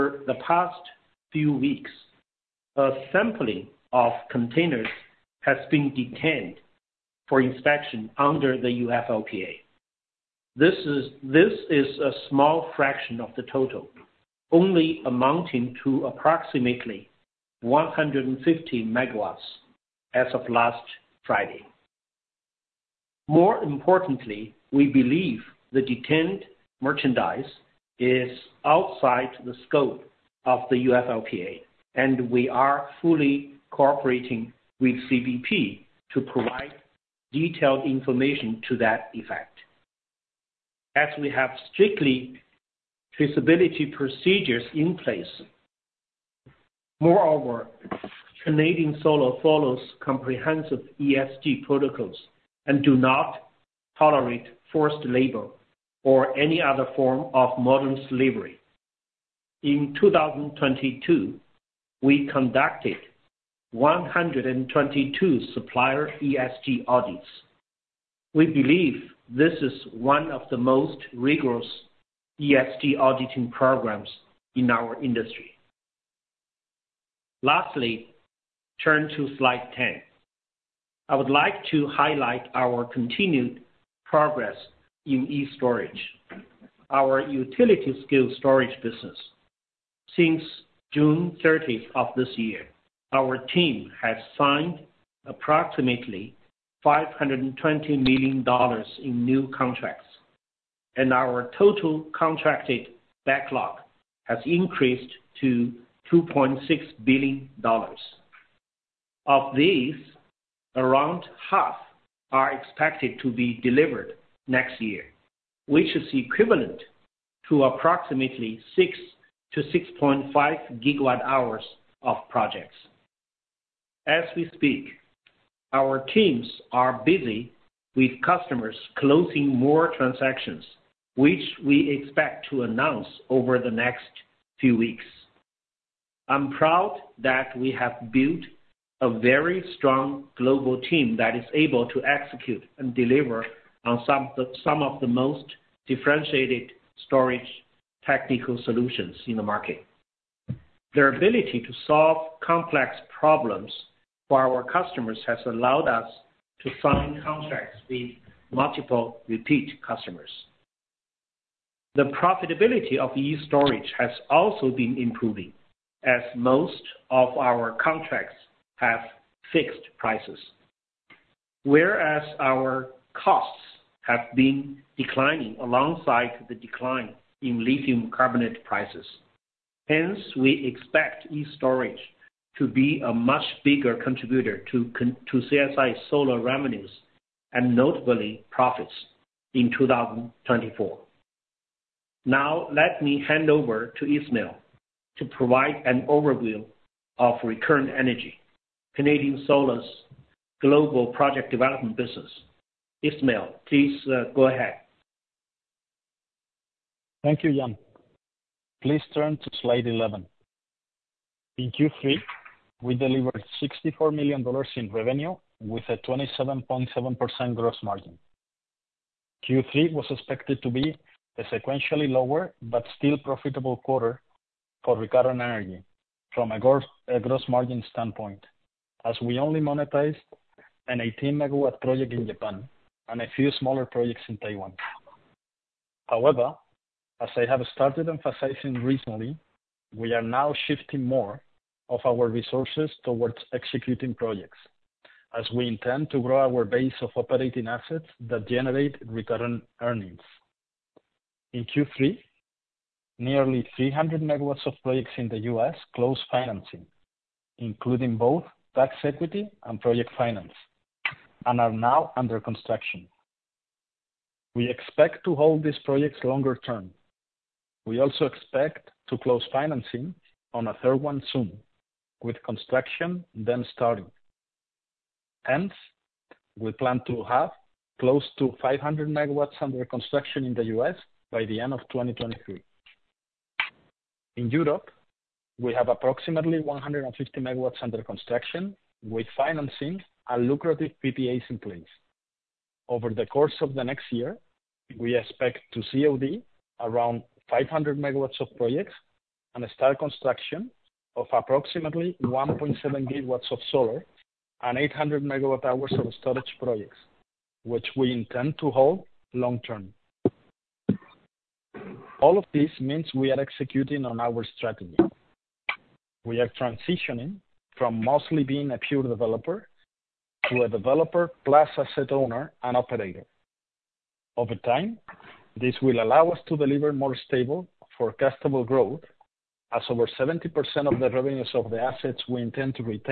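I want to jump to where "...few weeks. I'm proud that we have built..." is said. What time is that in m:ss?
2:14.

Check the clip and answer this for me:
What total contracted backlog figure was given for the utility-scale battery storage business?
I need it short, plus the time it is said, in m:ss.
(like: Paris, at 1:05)
$2.6 billion, at 1:46.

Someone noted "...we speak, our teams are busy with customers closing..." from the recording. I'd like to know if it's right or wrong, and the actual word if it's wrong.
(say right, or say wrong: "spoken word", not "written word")
right.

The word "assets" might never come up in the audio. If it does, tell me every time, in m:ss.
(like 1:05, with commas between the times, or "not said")
4:07, 5:21, 5:31.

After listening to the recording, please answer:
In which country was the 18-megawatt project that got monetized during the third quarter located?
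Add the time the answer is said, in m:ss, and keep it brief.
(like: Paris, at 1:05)
Japan, at 3:52.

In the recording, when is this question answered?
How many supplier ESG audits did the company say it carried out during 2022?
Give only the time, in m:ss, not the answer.
1:03.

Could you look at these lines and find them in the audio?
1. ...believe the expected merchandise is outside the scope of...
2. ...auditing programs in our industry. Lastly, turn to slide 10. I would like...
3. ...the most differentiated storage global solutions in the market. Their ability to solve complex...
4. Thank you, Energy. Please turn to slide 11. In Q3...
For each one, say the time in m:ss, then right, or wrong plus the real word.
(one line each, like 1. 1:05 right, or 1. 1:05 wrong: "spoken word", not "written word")
1. 0:24 wrong: "detained", not "expected"
2. 1:12 right
3. 2:24 wrong: "technical", not "global"
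4. 3:27 wrong: "Yan", not "Energy".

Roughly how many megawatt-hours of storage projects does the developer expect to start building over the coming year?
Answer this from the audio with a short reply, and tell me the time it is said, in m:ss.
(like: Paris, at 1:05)
800 MWh, at 5:04.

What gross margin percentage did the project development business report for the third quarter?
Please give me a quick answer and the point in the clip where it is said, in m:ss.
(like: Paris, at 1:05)
27.7%, at 3:35.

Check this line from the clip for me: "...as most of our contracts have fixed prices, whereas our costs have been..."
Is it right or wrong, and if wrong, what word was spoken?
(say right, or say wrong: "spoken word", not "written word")
right.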